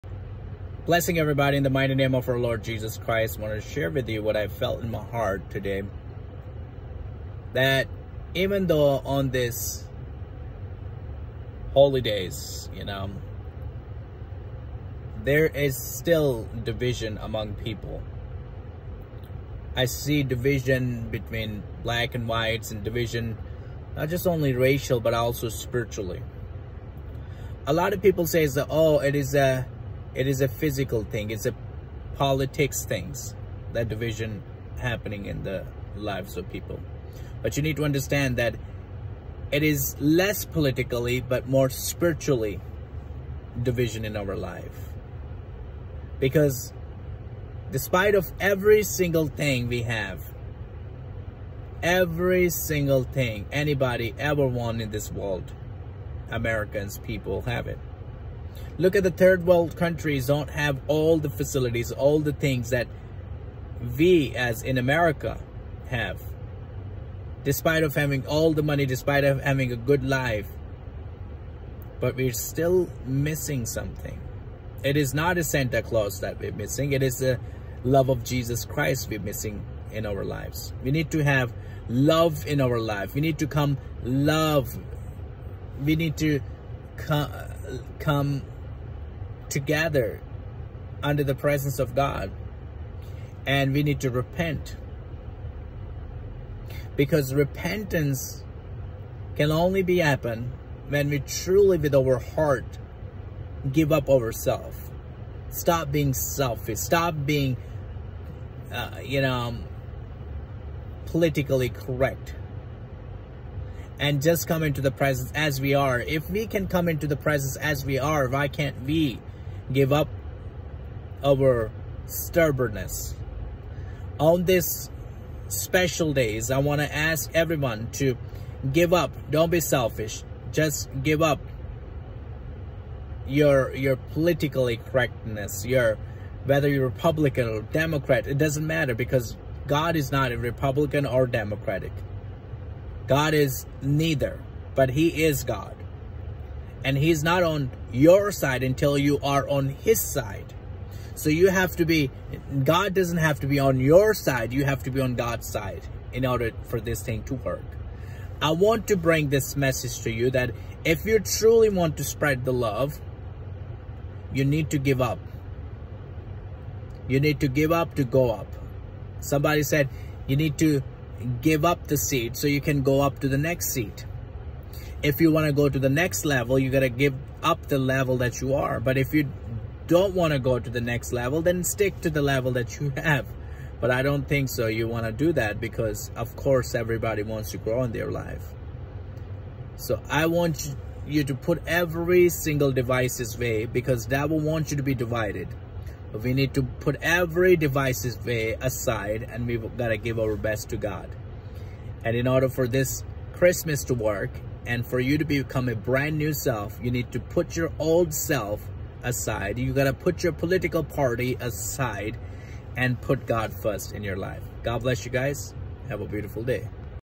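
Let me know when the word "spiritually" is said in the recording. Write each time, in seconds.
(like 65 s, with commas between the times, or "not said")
25 s, 41 s.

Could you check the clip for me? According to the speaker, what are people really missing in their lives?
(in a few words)
The love of Jesus Christ.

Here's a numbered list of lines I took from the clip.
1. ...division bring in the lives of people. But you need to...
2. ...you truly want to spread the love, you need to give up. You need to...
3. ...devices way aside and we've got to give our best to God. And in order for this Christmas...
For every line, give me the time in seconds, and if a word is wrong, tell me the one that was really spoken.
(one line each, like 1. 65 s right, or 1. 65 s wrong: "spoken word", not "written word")
1. 33 s wrong: "happening", not "bring"
2. 161 s right
3. 197 s right.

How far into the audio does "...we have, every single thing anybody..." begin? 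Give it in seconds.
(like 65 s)
49 s.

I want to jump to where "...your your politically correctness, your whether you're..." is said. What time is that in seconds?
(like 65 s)
133 s.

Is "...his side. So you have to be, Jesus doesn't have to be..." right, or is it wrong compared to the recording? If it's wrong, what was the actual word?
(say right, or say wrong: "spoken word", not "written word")
wrong: "God", not "Jesus".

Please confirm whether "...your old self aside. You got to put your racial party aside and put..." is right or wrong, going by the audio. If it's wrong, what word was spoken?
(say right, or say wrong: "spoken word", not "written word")
wrong: "political", not "racial".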